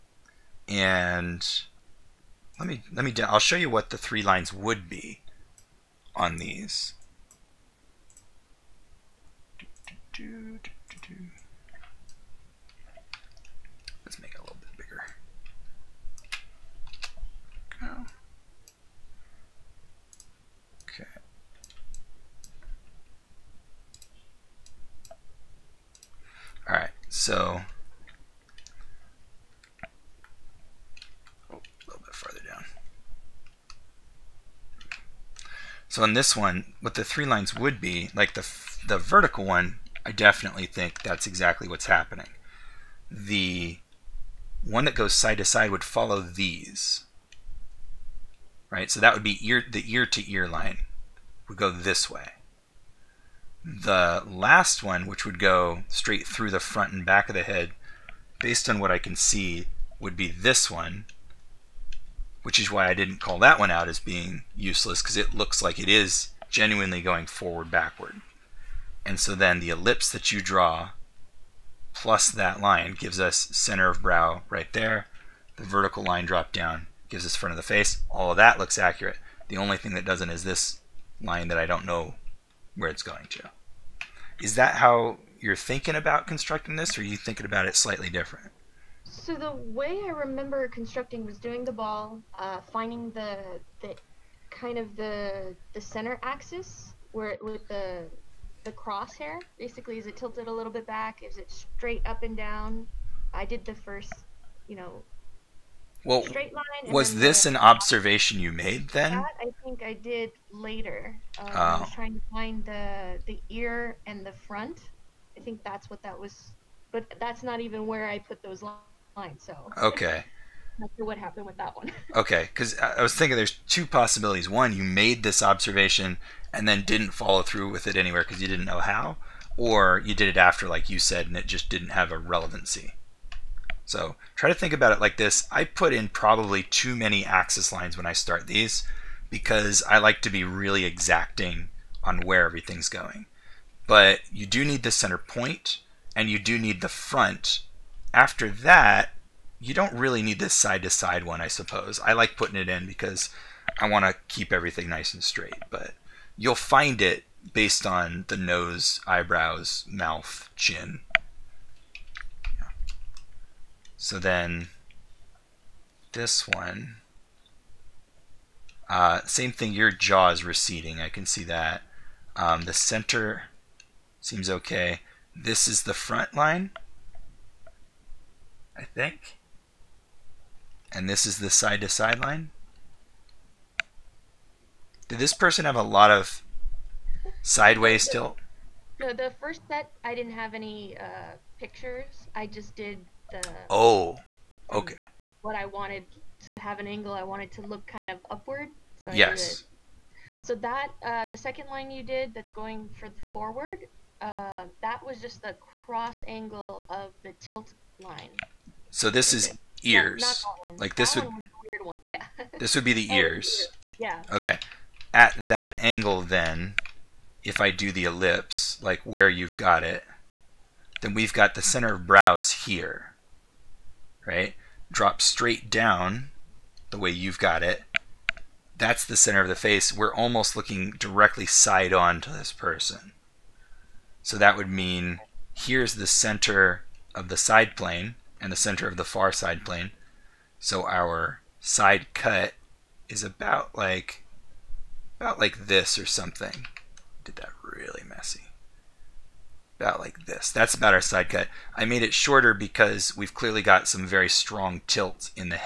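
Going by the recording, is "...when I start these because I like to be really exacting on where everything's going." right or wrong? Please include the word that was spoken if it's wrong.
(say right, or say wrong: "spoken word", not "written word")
right.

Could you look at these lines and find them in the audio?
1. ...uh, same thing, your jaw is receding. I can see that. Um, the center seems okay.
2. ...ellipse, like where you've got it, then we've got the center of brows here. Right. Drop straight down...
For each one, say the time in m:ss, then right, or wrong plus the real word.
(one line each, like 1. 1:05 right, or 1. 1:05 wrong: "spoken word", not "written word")
1. 2:48 right
2. 3:38 right.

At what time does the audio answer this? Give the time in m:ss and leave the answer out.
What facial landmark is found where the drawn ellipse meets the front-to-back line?
1:13.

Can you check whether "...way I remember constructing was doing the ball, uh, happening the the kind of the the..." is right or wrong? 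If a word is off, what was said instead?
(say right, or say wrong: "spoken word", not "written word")
wrong: "finding", not "happening".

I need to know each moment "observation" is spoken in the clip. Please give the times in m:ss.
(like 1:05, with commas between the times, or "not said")
1:47, 2:05.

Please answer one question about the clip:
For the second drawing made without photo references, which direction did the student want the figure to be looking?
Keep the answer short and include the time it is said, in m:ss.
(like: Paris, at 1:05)
upward, at 3:18.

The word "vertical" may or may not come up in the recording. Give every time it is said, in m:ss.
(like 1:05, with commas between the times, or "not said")
0:38, 1:15.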